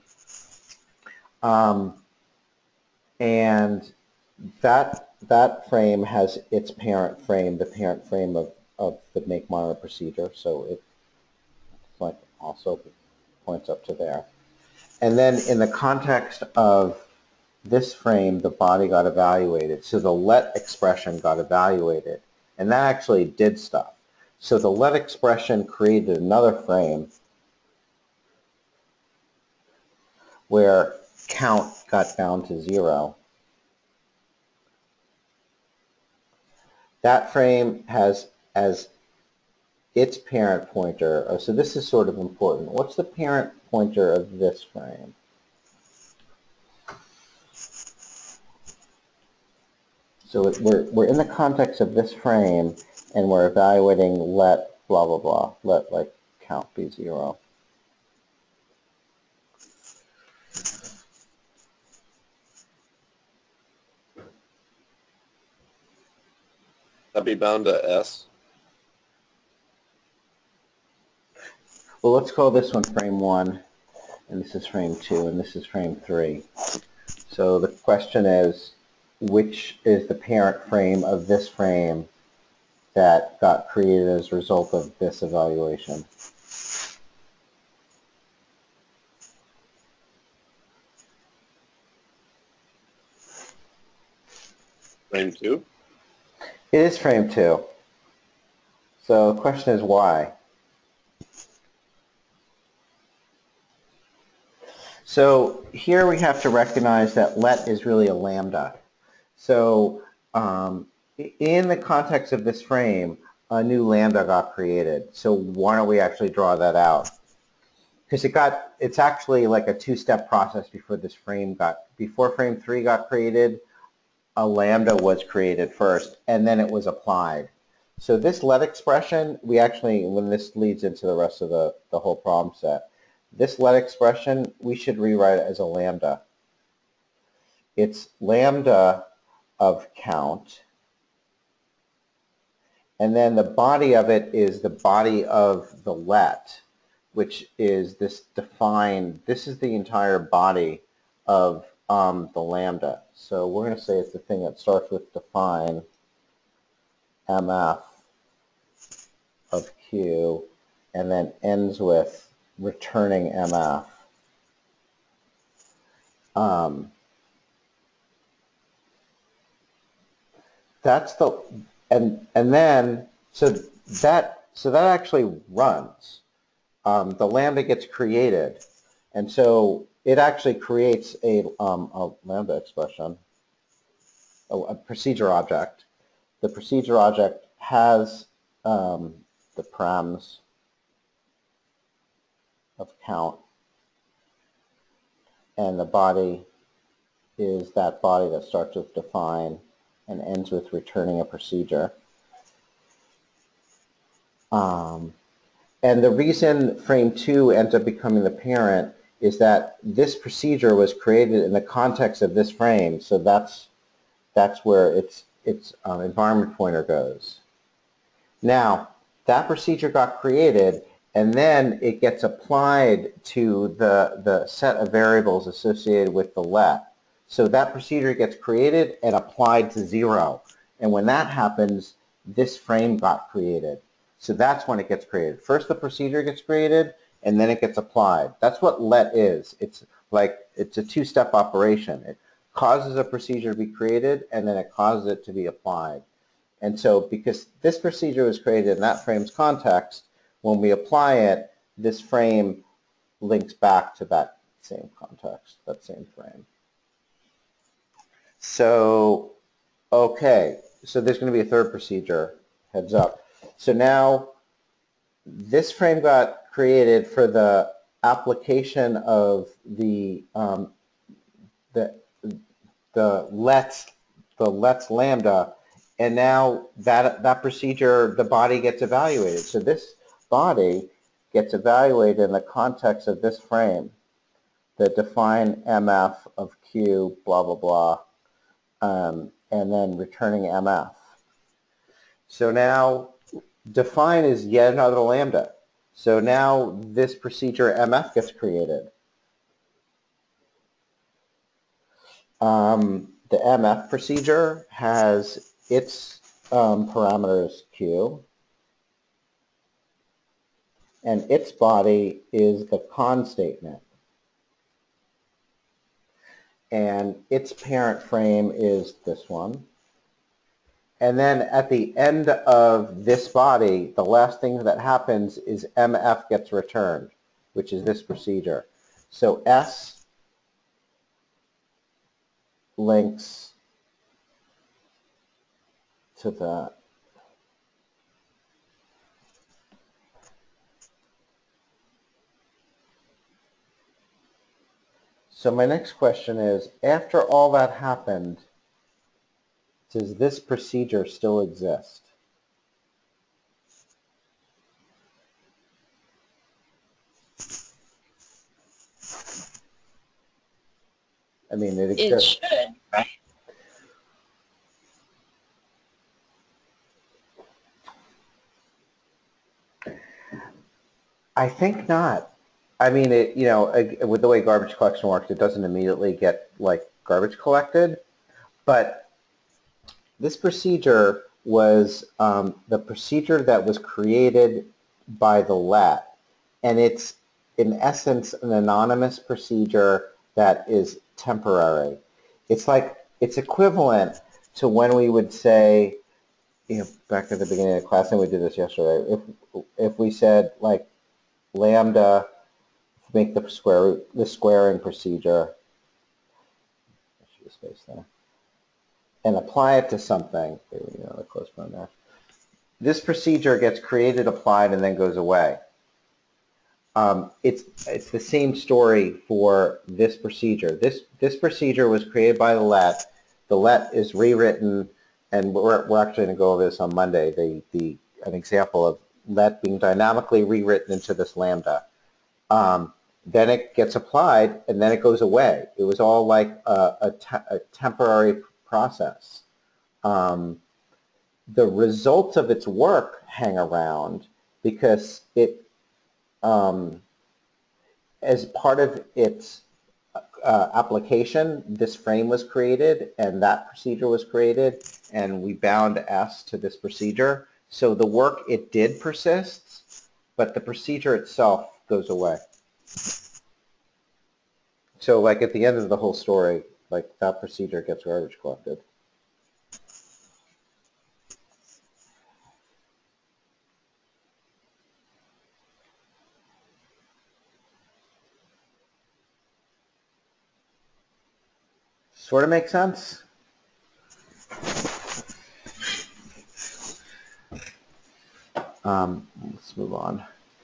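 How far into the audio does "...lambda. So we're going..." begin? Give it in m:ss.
2:32.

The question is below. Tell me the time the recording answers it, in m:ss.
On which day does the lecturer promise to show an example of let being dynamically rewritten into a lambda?
7:06.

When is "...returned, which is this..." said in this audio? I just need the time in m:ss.
5:26.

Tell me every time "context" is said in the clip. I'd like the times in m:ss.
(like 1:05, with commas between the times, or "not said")
0:15, 0:51, 1:51, 3:31, 4:09, 4:14, 4:42.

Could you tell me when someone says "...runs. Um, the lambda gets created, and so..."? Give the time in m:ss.
2:55.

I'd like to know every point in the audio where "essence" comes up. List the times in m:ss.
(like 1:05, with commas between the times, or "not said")
6:27.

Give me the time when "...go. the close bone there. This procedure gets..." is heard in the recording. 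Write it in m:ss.
6:50.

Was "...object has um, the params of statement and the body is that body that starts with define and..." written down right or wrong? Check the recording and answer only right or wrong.
wrong.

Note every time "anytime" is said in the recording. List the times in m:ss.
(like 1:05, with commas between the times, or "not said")
not said.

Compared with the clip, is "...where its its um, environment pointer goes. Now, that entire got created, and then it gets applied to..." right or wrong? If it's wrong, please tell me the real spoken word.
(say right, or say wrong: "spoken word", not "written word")
wrong: "procedure", not "entire".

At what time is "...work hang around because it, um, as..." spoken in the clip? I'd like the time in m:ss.
7:22.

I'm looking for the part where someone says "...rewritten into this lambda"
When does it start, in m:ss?
7:10.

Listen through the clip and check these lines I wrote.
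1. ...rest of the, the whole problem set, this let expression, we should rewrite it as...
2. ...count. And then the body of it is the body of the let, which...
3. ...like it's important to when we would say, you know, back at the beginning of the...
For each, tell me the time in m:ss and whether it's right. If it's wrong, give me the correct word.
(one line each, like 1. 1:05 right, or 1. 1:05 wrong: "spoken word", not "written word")
1. 2:11 right
2. 2:19 right
3. 6:32 wrong: "equivalent", not "important".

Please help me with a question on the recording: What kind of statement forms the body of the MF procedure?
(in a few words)
cond statement.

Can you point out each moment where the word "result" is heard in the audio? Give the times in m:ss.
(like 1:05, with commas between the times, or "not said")
1:24, 7:21.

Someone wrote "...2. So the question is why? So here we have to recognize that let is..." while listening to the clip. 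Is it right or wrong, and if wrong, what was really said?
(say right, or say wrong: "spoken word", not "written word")
right.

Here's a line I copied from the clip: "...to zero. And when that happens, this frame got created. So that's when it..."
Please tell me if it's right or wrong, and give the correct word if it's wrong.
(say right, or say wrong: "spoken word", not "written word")
right.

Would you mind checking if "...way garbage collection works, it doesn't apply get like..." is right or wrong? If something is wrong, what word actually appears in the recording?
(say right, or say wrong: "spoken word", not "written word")
wrong: "immediately", not "apply".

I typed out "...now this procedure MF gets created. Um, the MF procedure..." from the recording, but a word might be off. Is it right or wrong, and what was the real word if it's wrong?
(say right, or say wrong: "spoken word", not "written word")
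right.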